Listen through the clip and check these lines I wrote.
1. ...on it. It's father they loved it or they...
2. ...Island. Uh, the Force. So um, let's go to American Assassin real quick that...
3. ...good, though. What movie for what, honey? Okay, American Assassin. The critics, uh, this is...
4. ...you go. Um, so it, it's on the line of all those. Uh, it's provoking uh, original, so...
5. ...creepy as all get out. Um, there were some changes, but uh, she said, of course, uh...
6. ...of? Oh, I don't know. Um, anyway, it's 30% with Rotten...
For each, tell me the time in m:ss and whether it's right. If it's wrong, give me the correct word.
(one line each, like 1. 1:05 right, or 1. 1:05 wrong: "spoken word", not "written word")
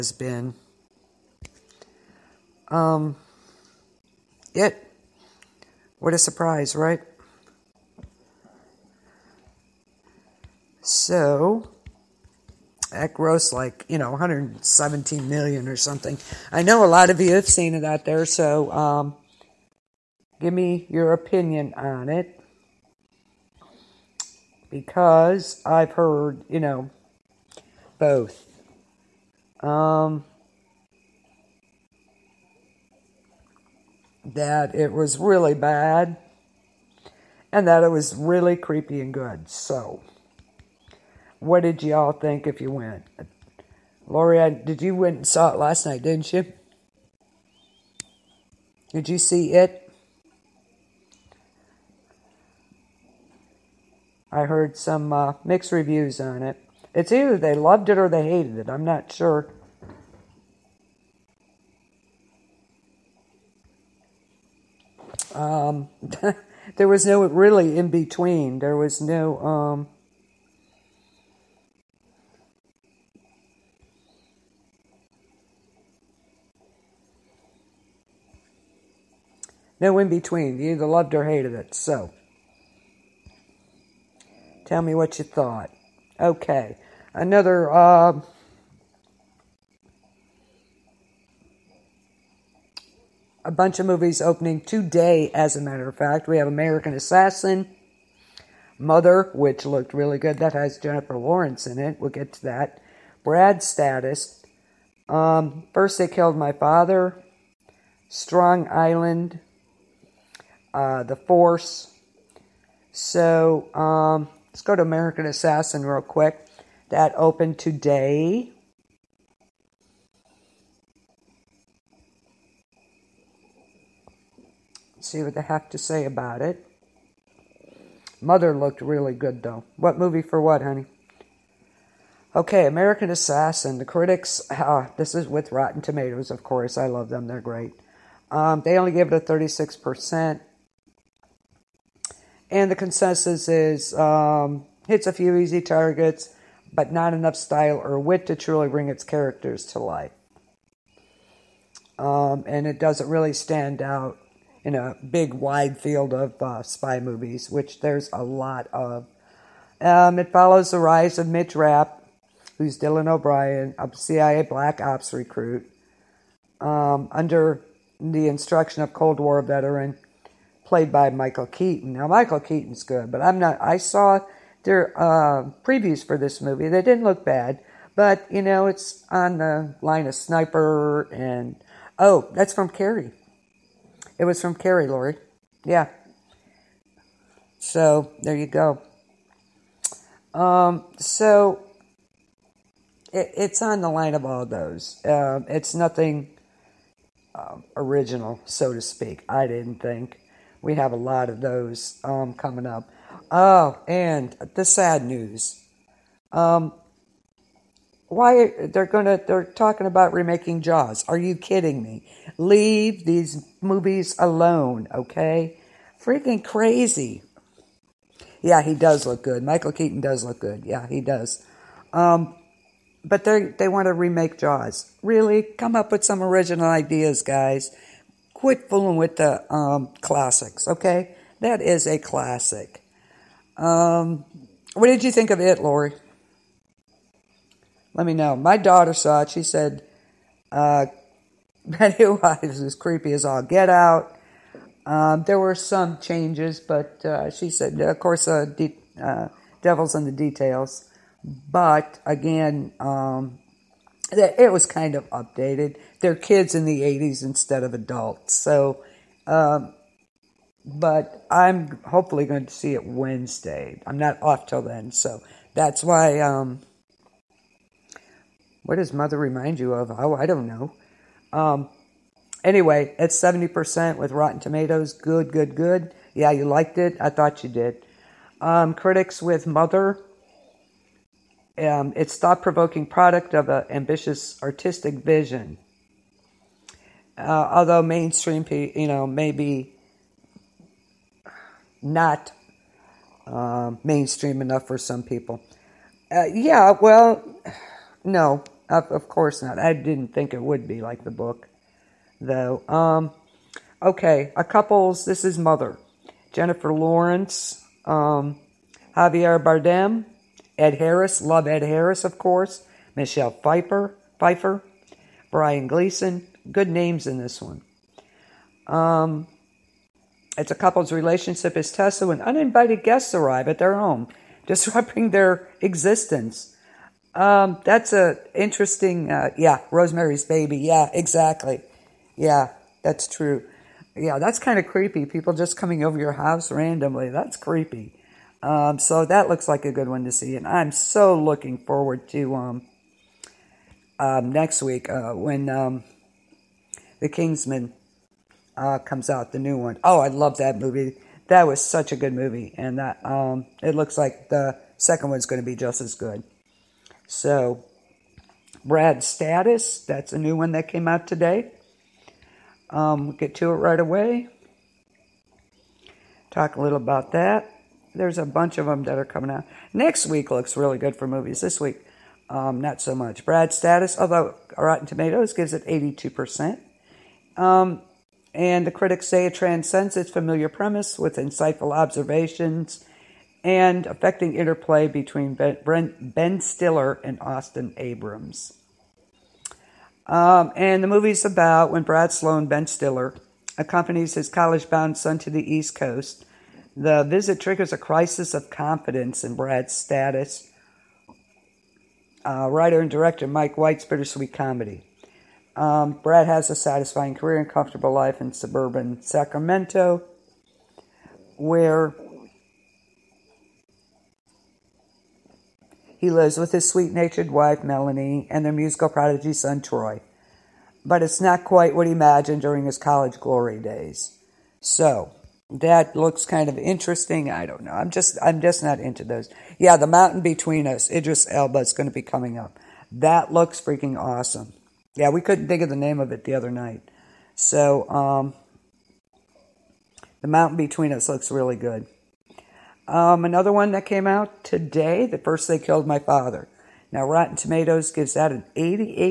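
1. 0:56 wrong: "either", not "father"
2. 1:48 right
3. 2:09 right
4. 3:08 wrong: "nothing", not "provoking"
5. 4:02 right
6. 4:29 wrong: "70", not "30".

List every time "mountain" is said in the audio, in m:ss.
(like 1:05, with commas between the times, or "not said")
7:09, 7:20.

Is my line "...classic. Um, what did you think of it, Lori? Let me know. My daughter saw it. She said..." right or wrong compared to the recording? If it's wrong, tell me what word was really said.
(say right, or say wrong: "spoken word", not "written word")
right.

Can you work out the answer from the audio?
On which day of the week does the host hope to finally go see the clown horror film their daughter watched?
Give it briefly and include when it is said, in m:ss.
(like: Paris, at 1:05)
Wednesday, at 4:22.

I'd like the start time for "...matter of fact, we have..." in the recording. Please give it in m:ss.
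1:35.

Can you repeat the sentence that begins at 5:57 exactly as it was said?
So, Brad Status, that's a new one that came out today.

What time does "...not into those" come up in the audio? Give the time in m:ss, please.
7:08.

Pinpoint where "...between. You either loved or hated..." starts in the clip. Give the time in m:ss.
1:20.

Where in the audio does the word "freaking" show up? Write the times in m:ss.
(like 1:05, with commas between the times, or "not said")
3:36, 7:13.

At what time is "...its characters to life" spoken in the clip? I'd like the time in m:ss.
2:28.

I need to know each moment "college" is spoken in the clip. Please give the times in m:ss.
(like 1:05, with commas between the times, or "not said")
6:34, 7:02.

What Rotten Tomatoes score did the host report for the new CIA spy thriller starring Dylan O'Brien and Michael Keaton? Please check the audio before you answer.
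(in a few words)
36%.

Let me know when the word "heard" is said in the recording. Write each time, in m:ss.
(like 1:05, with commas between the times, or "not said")
0:25, 0:54.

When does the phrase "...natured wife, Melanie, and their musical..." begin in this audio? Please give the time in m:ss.
6:56.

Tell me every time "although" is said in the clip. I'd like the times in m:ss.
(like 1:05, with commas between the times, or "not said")
4:47, 6:13.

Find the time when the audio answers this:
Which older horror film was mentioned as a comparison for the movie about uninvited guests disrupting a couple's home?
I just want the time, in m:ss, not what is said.
5:29.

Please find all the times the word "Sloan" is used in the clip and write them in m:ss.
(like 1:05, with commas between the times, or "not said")
6:32.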